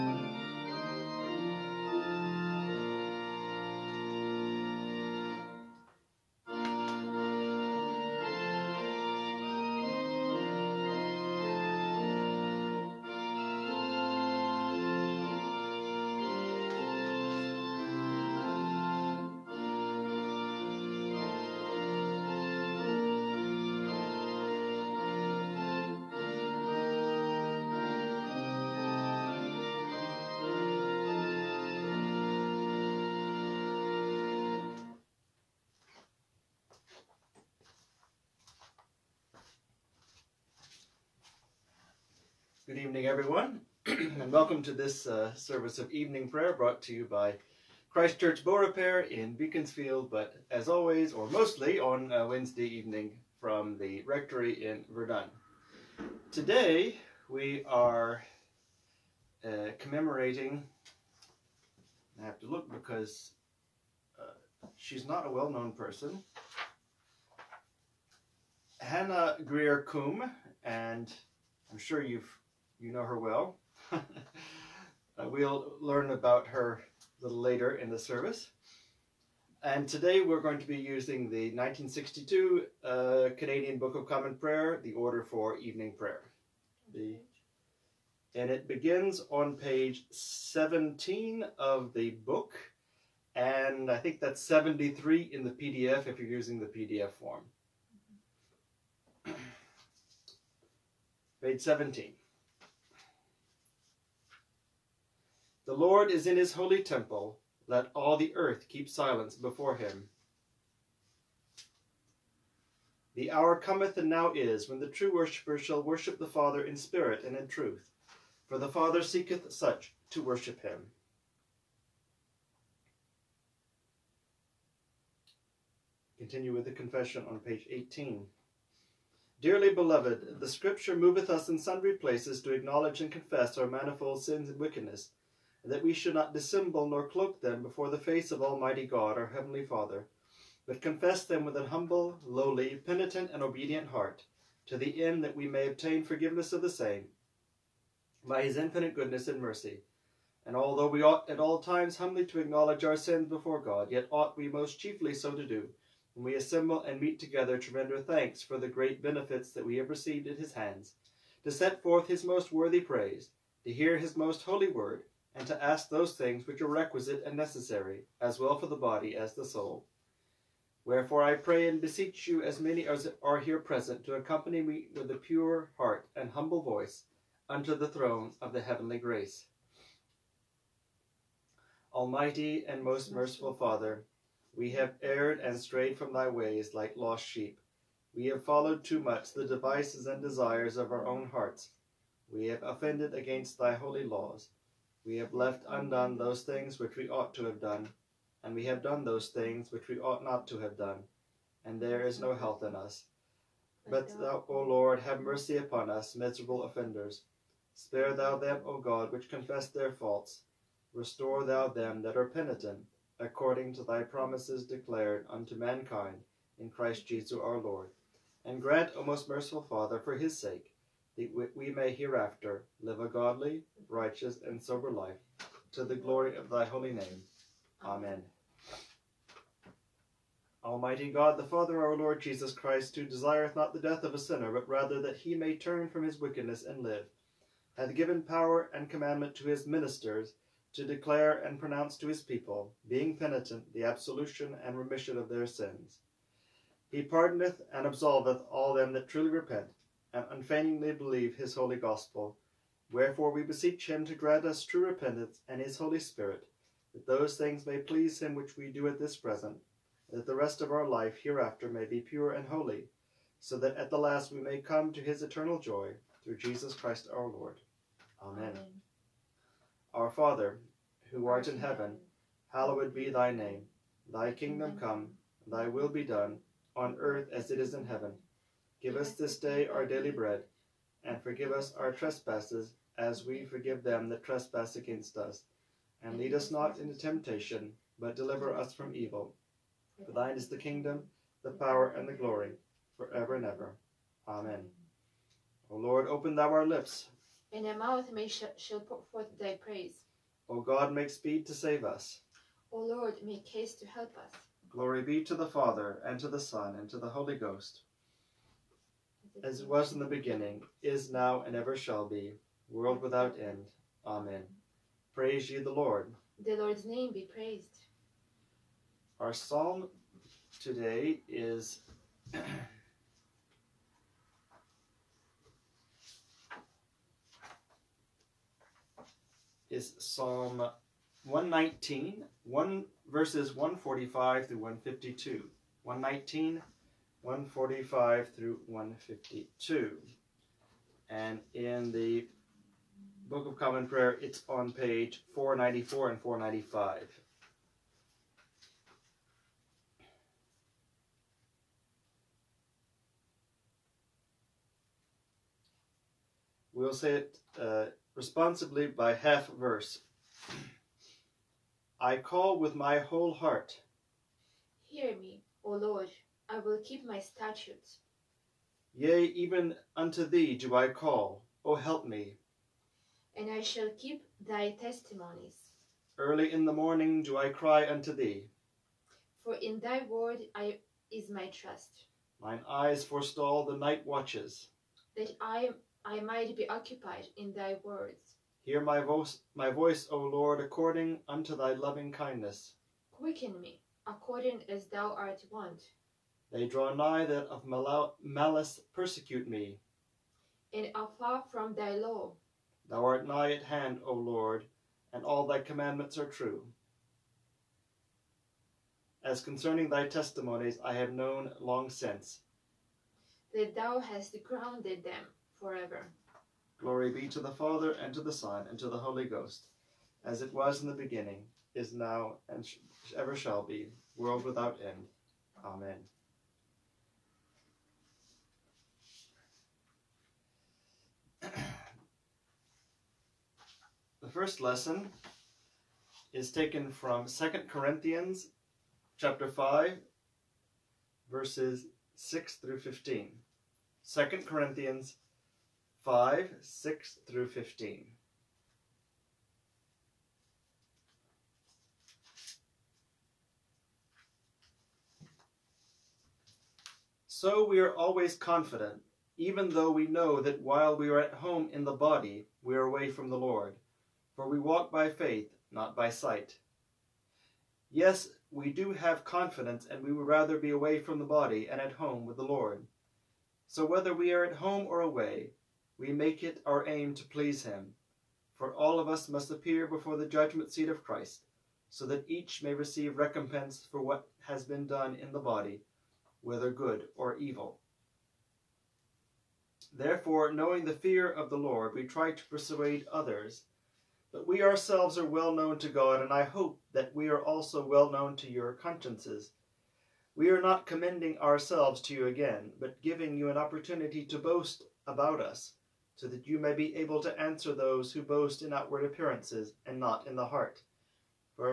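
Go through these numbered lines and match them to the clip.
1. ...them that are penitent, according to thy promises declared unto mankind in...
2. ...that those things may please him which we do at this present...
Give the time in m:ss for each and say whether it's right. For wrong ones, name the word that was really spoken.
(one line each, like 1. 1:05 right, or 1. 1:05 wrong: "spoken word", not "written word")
1. 3:31 right
2. 4:16 right.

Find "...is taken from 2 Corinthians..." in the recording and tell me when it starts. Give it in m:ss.
7:16.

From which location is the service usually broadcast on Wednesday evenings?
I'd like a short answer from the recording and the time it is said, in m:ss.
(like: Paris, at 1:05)
the rectory in Verdun, at 0:53.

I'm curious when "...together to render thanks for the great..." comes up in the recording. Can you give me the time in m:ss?
2:37.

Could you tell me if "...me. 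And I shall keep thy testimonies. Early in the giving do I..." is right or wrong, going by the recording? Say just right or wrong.
wrong.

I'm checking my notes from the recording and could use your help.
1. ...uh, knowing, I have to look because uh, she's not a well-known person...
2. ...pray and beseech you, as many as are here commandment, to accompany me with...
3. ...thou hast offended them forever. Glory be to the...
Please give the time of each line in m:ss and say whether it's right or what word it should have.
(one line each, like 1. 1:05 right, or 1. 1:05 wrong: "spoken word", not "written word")
1. 0:59 wrong: "commemorating", not "knowing"
2. 2:51 wrong: "present", not "commandment"
3. 6:53 wrong: "grounded", not "offended".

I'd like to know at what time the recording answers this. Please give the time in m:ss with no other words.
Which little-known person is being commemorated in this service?
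1:08.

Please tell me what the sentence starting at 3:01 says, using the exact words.
Almighty and most merciful Father, we have erred and strayed from thy ways like lost sheep.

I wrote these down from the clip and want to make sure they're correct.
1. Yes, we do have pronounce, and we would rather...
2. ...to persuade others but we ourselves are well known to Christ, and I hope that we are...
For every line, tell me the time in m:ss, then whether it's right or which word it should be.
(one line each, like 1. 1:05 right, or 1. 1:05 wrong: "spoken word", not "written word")
1. 7:47 wrong: "confidence", not "pronounce"
2. 8:12 wrong: "God", not "Christ".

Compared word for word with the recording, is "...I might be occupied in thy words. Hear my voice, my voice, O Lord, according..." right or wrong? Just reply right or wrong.
right.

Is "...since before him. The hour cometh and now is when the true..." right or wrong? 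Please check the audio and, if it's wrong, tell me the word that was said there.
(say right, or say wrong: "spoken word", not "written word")
wrong: "silence", not "since".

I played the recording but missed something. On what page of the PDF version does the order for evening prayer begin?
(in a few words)
73.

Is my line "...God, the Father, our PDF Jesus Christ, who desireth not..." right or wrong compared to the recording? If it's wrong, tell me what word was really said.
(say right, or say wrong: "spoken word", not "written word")
wrong: "Lord", not "PDF".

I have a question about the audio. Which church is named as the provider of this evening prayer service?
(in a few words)
Christchurch Bow Repair.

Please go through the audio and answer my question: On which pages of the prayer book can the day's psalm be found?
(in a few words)
494 and 495.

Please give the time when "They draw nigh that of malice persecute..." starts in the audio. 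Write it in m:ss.
6:36.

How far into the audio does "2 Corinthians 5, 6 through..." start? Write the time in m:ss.
7:24.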